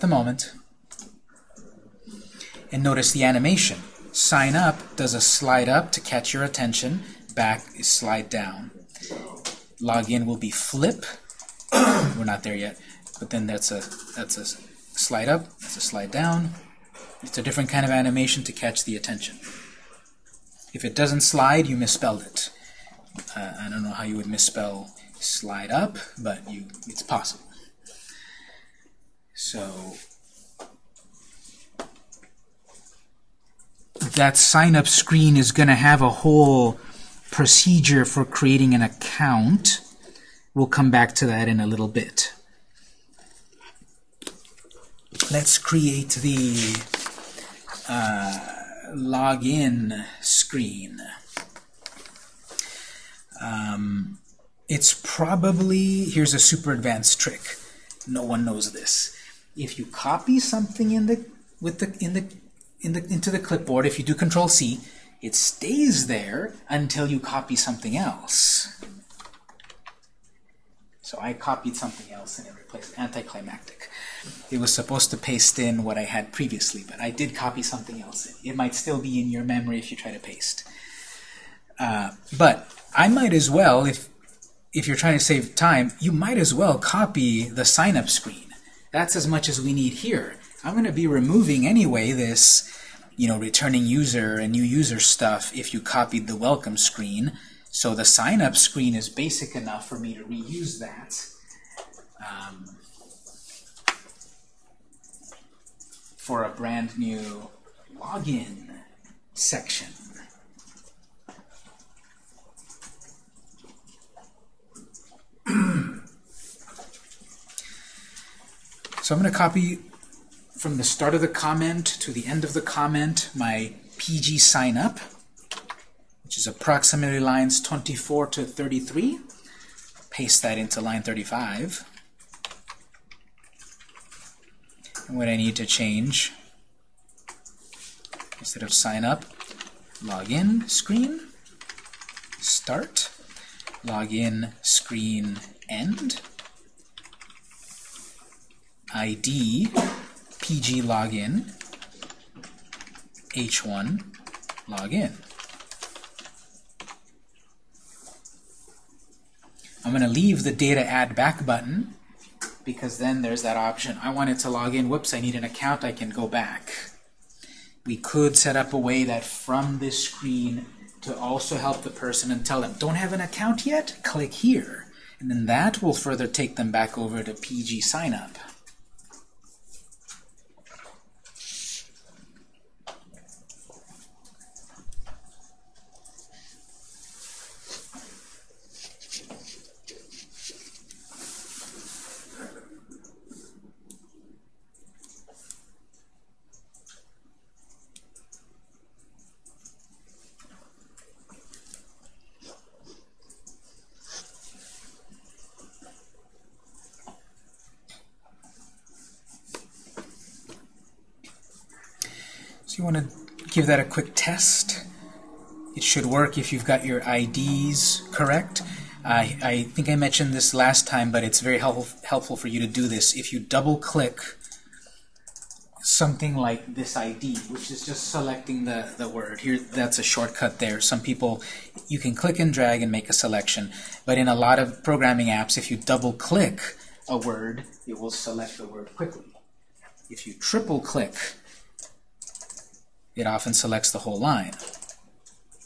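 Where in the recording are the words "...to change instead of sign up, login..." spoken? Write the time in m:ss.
2:15.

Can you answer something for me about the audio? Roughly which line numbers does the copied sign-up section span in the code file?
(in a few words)
24 to 33.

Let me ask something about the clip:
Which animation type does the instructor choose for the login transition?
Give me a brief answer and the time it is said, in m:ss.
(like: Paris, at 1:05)
Flip, at 0:09.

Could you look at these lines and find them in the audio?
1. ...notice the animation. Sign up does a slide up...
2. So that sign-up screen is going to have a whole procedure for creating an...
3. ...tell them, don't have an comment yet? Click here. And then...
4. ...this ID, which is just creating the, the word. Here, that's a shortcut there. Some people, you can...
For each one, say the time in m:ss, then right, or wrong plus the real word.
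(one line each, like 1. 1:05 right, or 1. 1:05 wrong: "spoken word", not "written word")
1. 0:02 right
2. 0:29 right
3. 2:52 wrong: "account", not "comment"
4. 3:46 wrong: "selecting", not "creating".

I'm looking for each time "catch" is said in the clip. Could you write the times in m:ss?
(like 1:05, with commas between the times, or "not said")
0:06, 0:18.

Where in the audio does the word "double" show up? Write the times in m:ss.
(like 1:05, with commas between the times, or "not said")
3:43, 3:55.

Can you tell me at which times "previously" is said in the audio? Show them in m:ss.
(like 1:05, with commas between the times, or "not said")
1:16.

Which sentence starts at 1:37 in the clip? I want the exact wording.
So the sign-up screen is basic enough for me to reuse that.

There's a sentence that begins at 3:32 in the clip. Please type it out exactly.
you want to give that a quick test.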